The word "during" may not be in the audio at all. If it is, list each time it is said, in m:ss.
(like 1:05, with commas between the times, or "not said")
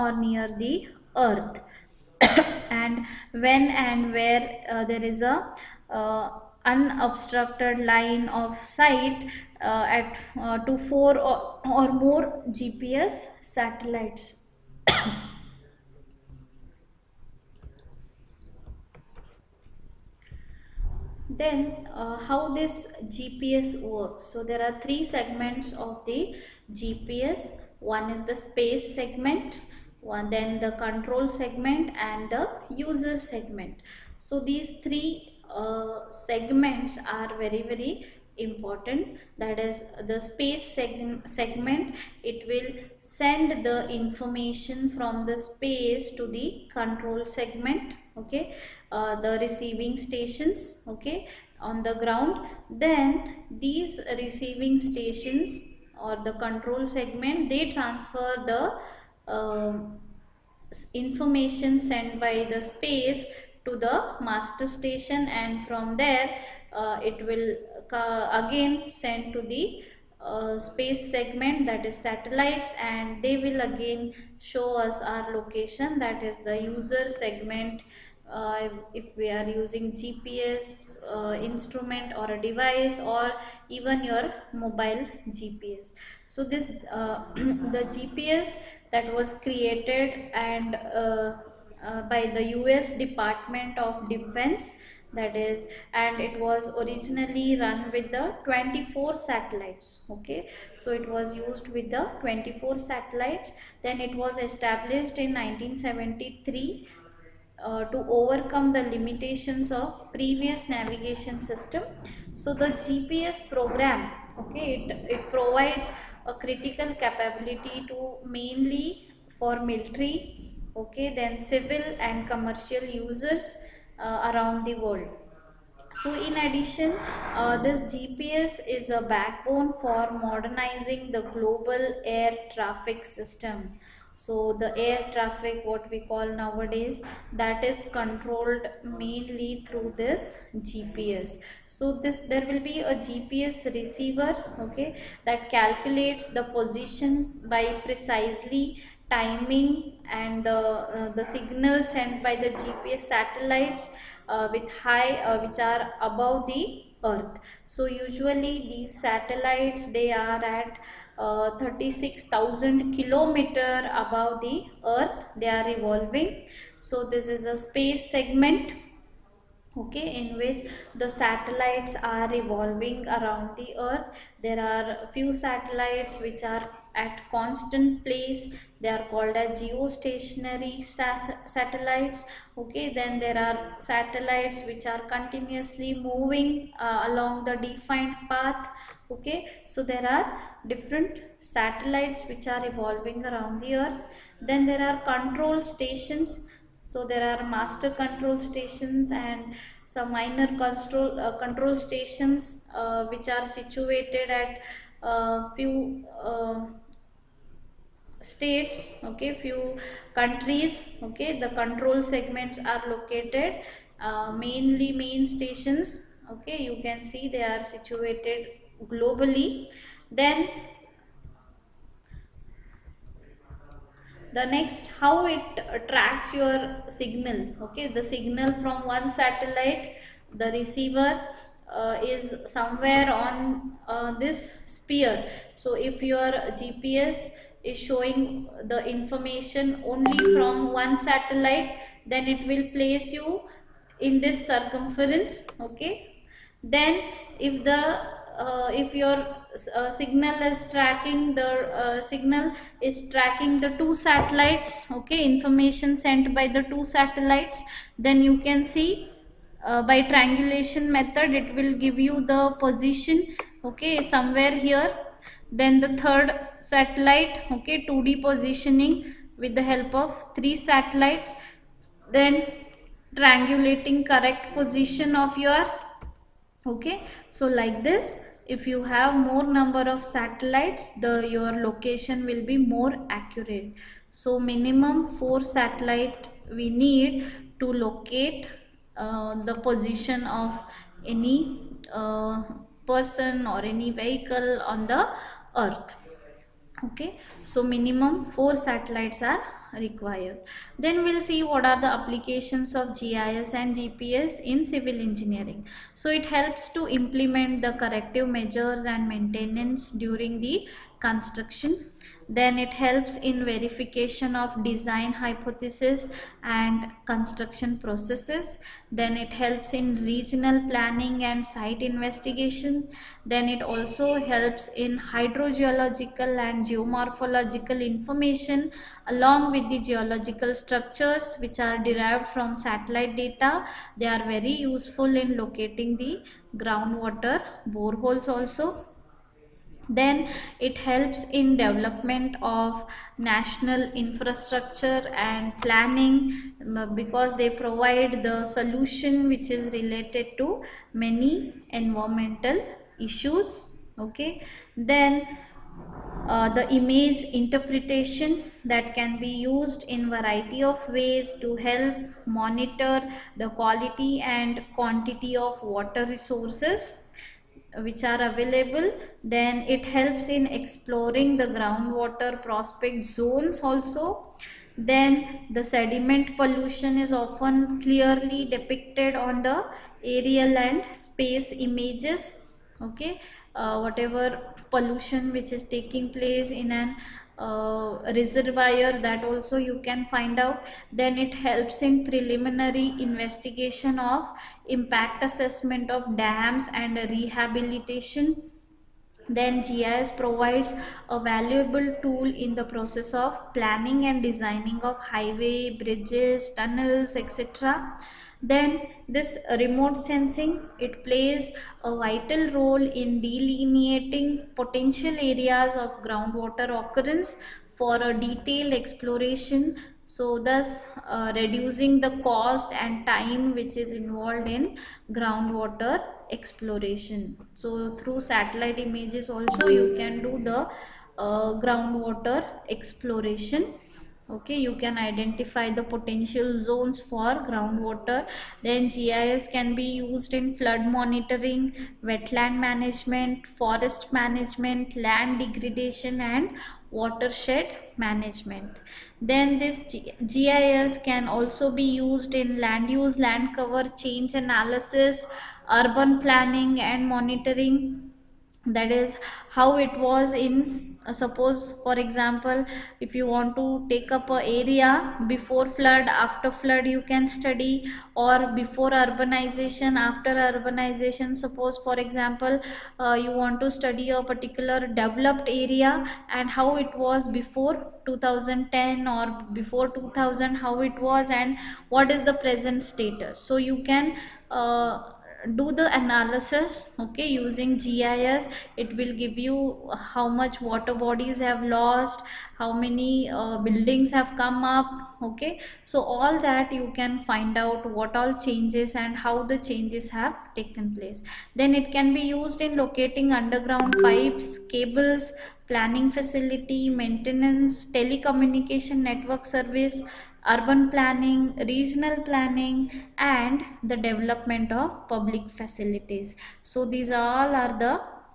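5:09.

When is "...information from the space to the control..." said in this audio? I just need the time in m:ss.
0:43.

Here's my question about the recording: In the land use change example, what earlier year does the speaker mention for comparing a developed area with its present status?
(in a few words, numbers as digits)
2010.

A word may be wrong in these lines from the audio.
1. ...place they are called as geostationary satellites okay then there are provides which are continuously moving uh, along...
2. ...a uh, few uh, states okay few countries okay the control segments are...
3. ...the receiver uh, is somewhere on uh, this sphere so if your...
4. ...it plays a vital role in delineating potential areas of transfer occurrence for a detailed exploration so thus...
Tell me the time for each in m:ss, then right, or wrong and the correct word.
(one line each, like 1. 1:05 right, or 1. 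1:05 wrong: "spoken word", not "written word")
1. 2:58 wrong: "satellites", not "provides"
2. 3:25 right
3. 3:50 right
4. 6:50 wrong: "groundwater", not "transfer".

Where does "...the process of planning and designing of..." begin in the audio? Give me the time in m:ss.
6:42.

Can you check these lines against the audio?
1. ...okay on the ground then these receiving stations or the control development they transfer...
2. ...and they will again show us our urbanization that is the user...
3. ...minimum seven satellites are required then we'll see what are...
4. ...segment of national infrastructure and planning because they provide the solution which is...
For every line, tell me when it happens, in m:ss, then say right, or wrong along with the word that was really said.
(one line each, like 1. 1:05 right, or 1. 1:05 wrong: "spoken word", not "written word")
1. 0:50 wrong: "segment", not "development"
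2. 1:12 wrong: "location", not "urbanization"
3. 4:57 wrong: "four", not "seven"
4. 5:41 wrong: "development", not "segment".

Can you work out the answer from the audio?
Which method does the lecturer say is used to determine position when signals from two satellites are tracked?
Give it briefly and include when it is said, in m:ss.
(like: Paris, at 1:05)
triangulation, at 4:20.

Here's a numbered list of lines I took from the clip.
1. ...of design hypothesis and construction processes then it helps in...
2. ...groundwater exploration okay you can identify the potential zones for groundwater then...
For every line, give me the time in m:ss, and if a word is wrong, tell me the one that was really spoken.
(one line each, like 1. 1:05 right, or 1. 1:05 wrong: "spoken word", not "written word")
1. 5:14 right
2. 7:11 right.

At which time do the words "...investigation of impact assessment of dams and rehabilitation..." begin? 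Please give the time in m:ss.
6:32.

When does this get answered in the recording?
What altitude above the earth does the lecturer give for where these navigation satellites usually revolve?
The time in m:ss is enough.
2:41.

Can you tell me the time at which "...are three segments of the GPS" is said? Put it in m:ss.
0:24.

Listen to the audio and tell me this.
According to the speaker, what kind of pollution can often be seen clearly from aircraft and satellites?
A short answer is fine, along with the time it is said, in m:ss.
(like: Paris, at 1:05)
sediment pollution, at 6:15.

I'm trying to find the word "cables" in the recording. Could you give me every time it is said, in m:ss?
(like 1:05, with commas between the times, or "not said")
8:24.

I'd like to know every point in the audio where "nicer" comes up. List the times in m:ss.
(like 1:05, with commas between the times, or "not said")
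not said.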